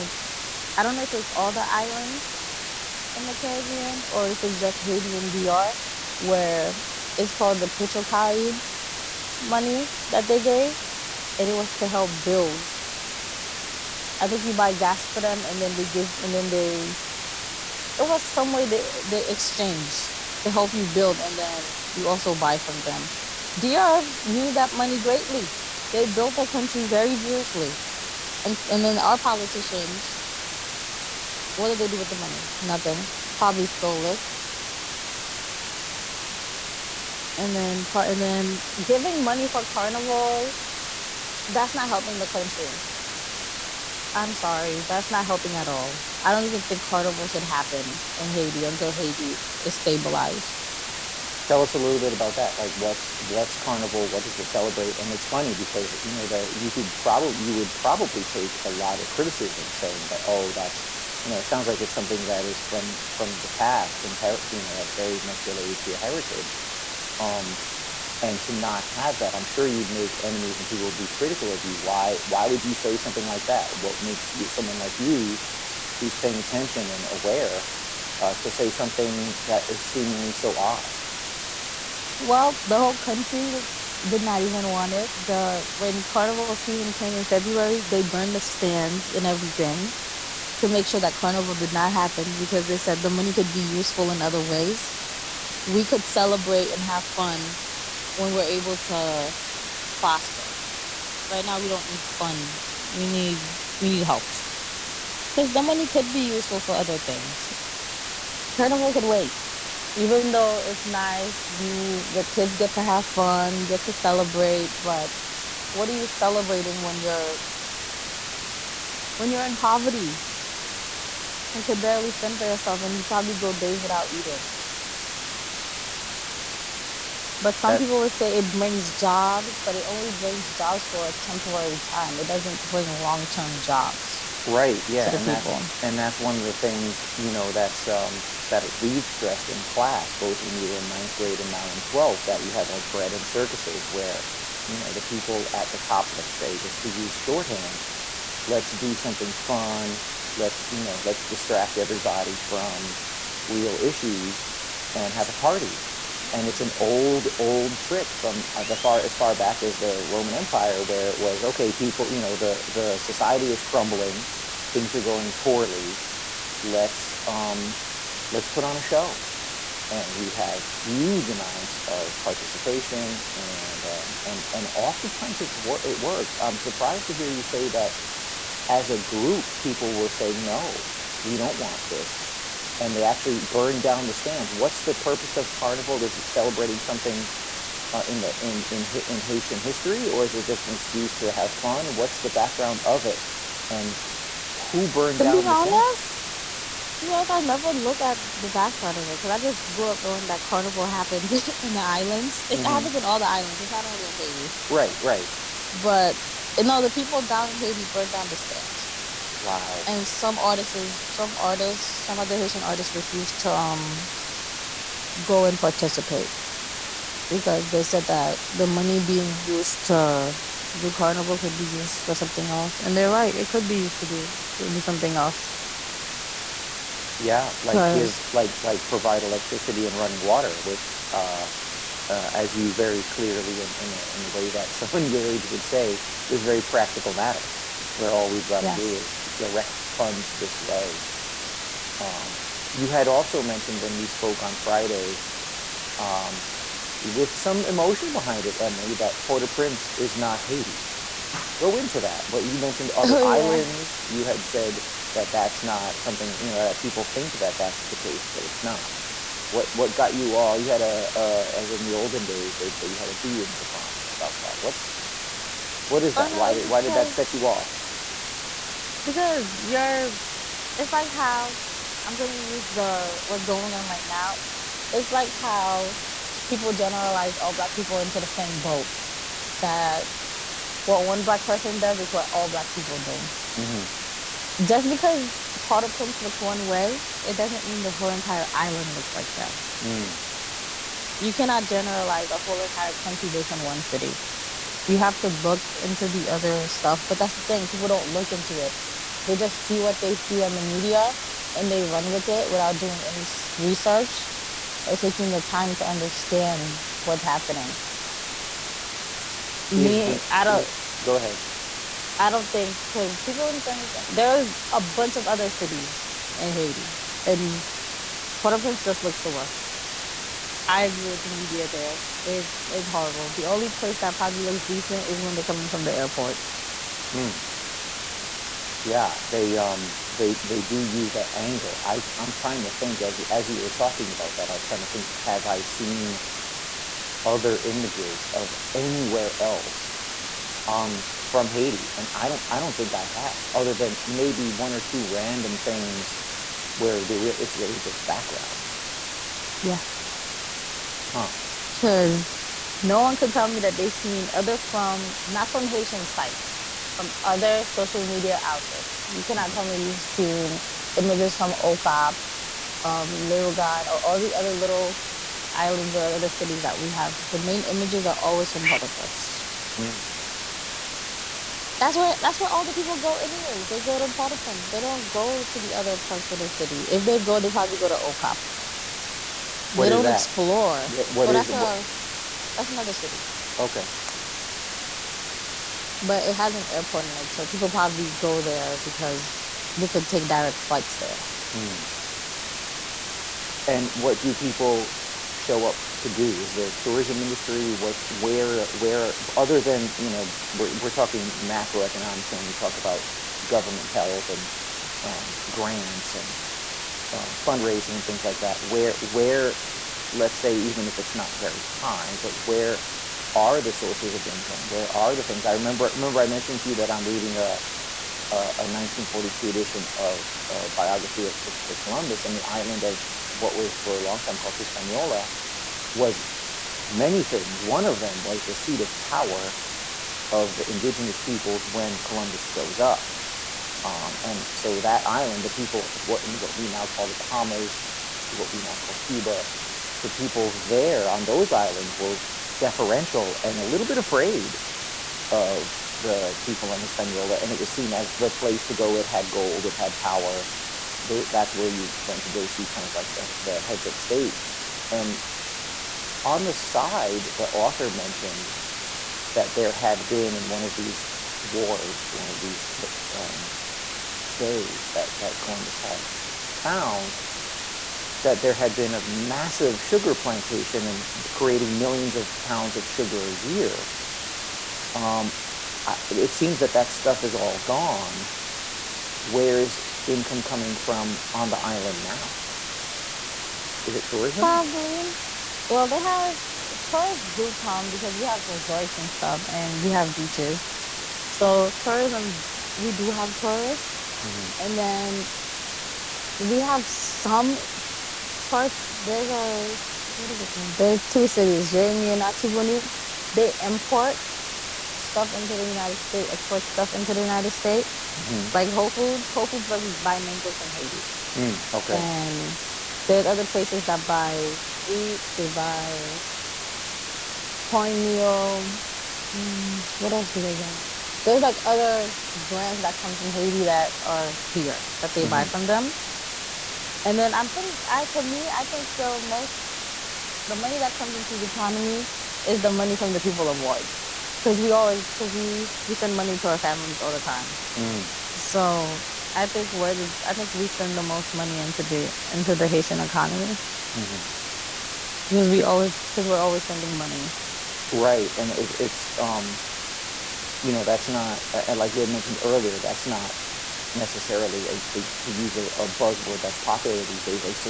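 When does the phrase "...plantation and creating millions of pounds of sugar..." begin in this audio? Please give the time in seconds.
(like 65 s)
470 s.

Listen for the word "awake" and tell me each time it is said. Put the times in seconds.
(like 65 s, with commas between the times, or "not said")
not said.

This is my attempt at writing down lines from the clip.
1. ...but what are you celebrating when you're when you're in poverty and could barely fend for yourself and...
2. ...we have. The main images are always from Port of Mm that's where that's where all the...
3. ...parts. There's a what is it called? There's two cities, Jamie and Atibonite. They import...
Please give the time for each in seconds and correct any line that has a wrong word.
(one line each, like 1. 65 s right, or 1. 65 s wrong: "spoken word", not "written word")
1. 114 s right
2. 366 s right
3. 498 s right.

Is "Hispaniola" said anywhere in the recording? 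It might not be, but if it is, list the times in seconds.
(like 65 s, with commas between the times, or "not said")
424 s, 446 s.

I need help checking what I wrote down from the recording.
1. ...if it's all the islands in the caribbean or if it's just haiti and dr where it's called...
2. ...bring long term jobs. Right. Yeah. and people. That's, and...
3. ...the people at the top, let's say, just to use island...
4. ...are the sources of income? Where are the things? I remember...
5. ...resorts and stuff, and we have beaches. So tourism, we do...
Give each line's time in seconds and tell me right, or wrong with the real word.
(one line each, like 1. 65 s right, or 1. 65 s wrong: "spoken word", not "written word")
1. 1 s right
2. 132 s right
3. 144 s wrong: "shorthand", not "island"
4. 413 s right
5. 488 s right.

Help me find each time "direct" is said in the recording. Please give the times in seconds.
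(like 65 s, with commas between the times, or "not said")
239 s, 390 s.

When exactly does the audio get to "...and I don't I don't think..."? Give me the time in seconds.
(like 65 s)
341 s.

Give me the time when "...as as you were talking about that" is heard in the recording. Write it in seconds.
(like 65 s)
333 s.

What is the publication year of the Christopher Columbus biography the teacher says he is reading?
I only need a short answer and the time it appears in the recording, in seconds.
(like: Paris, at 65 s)
1942, at 418 s.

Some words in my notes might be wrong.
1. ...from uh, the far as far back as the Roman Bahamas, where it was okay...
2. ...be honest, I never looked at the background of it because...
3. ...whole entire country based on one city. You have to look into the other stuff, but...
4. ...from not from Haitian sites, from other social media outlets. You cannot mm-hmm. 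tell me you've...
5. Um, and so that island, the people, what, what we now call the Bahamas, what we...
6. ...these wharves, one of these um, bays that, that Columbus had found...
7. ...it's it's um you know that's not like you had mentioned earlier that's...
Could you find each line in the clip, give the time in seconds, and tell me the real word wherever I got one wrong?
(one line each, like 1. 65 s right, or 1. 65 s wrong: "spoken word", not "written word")
1. 158 s wrong: "Empire", not "Bahamas"
2. 197 s right
3. 292 s right
4. 354 s right
5. 433 s right
6. 460 s right
7. 548 s right.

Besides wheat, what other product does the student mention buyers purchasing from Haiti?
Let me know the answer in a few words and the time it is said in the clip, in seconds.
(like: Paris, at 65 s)
cornmeal, at 517 s.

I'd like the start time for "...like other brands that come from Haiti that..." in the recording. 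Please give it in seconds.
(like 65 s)
521 s.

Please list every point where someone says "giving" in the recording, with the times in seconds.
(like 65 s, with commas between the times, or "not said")
38 s.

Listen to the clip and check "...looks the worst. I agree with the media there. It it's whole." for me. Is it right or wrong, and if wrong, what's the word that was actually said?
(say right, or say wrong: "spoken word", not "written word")
wrong: "horrible", not "whole".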